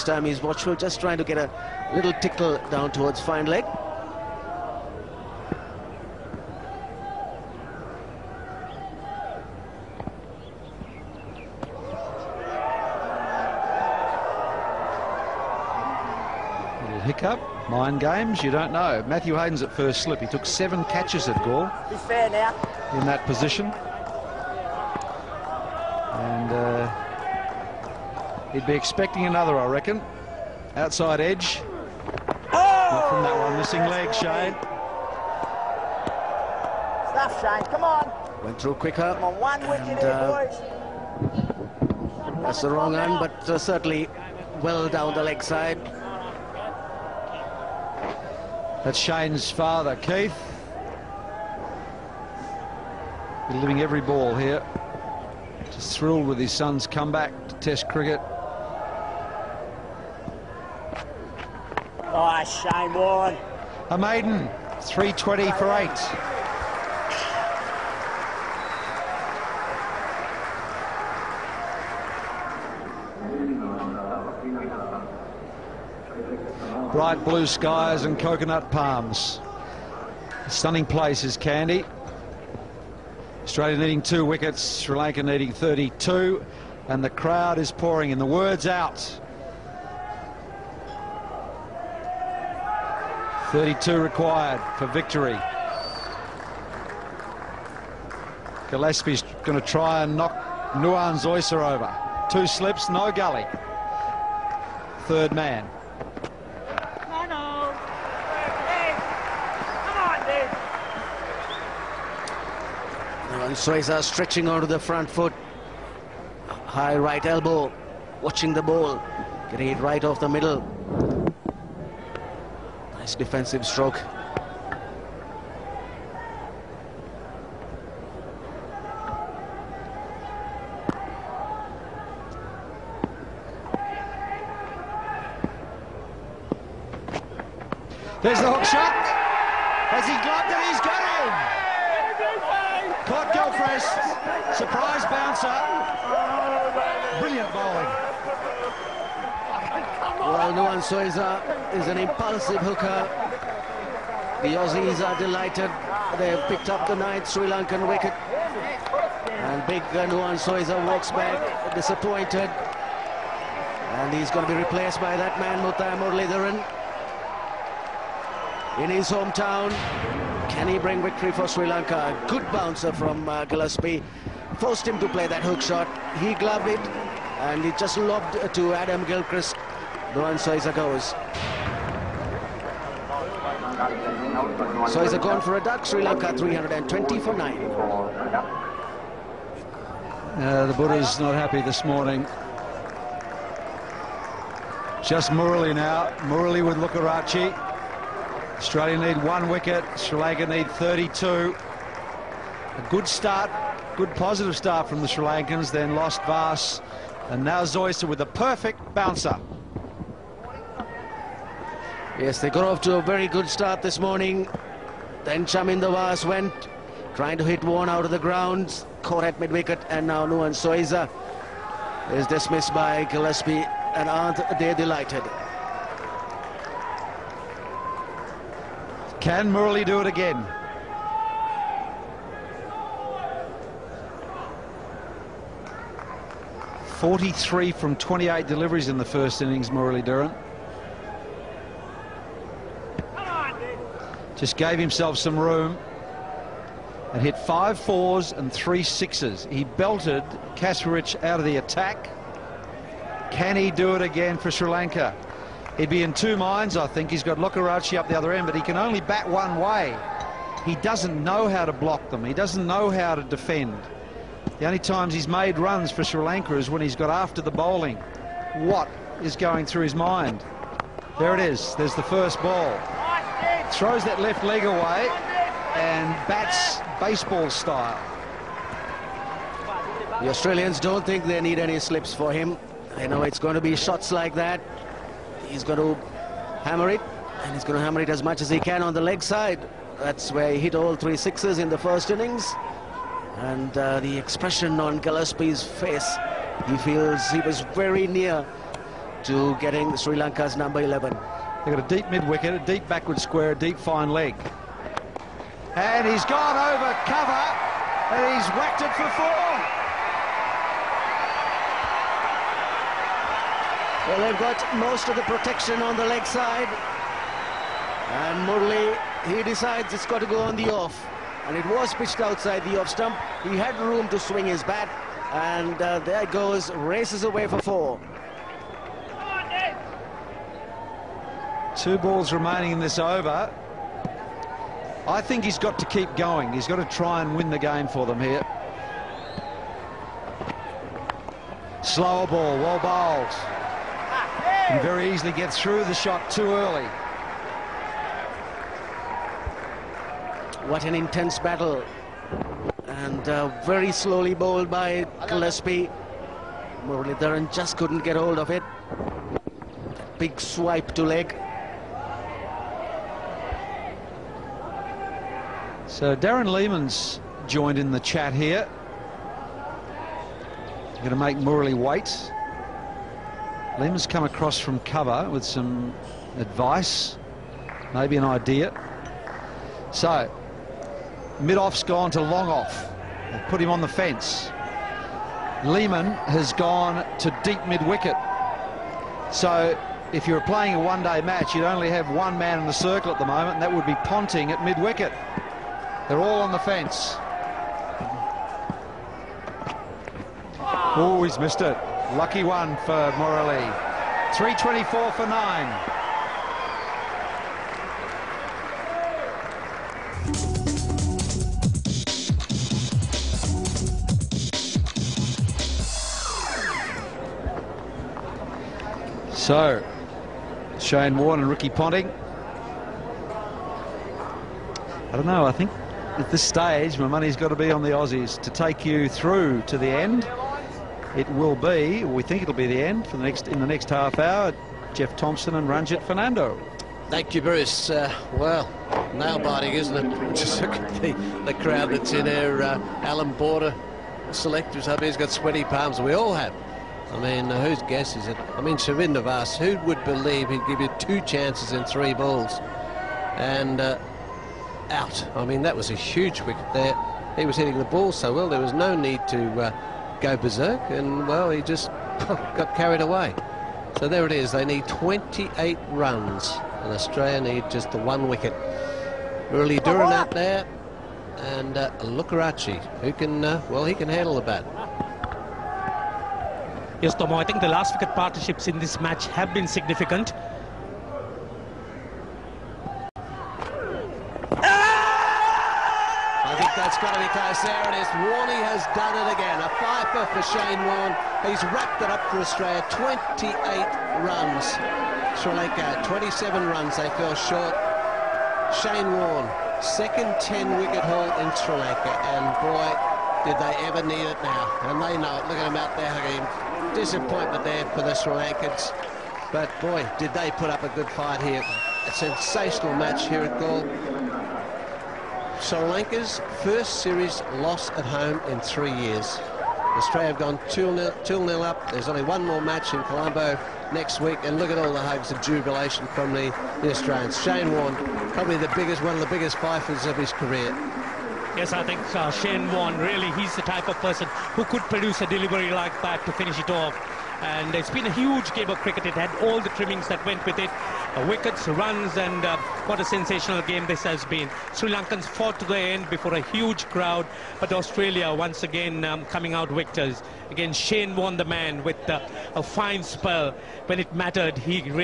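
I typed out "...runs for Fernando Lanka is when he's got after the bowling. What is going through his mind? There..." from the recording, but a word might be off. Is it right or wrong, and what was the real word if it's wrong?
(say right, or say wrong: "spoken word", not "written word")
wrong: "Sri", not "Fernando".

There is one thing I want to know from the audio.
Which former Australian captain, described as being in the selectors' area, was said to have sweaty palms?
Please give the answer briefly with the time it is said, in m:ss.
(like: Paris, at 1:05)
Alan Border, at 7:23.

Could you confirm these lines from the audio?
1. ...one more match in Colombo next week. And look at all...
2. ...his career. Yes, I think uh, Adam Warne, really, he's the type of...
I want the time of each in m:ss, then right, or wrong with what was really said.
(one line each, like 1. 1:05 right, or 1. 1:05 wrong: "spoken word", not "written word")
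1. 8:42 right
2. 8:50 wrong: "Shane", not "Adam".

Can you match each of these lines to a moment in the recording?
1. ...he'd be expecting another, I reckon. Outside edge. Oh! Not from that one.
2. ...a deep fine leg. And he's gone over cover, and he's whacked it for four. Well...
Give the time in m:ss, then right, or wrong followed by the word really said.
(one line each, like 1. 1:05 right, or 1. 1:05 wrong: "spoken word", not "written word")
1. 0:28 right
2. 5:03 right.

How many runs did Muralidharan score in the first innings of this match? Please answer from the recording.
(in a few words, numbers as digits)
43.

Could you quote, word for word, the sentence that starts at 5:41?
Slower ball, well bowled very easily get through the shot too early.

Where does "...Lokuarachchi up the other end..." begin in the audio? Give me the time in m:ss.
4:17.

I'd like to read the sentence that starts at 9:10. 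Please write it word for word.
Again, Shane Warne the man with uh, a fine spell.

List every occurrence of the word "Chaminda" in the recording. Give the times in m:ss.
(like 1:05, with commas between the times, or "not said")
3:35, 7:28.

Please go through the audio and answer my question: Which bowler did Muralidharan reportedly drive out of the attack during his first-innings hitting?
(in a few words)
Kasprowicz.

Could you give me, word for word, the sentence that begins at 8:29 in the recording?
But boy, did they put up a good fight here.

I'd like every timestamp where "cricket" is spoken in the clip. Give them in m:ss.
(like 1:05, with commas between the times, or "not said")
0:57, 8:58.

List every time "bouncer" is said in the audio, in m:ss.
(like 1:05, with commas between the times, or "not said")
2:25, 2:52, 3:28.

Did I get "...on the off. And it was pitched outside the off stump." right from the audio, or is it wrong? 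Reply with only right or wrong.
right.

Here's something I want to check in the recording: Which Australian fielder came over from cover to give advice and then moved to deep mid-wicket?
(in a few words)
Darren Lehmann.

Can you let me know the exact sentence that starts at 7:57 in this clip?
Yes, Tomo, I think the last wicket partnerships in this match have been significant.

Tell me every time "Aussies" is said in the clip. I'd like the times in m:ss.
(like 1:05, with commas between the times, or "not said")
2:34, 7:07.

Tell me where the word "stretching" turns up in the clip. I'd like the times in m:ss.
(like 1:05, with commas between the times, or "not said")
1:54.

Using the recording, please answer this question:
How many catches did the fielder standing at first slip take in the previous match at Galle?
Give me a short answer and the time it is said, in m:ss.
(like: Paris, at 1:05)
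7, at 0:20.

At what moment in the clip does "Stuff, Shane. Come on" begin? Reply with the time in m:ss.
0:37.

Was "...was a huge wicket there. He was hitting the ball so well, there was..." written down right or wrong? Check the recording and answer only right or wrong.
right.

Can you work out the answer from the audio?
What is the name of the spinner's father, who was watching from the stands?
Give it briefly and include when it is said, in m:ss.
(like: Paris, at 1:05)
Keith, at 0:49.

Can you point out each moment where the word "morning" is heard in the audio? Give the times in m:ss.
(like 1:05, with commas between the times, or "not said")
3:11, 3:33.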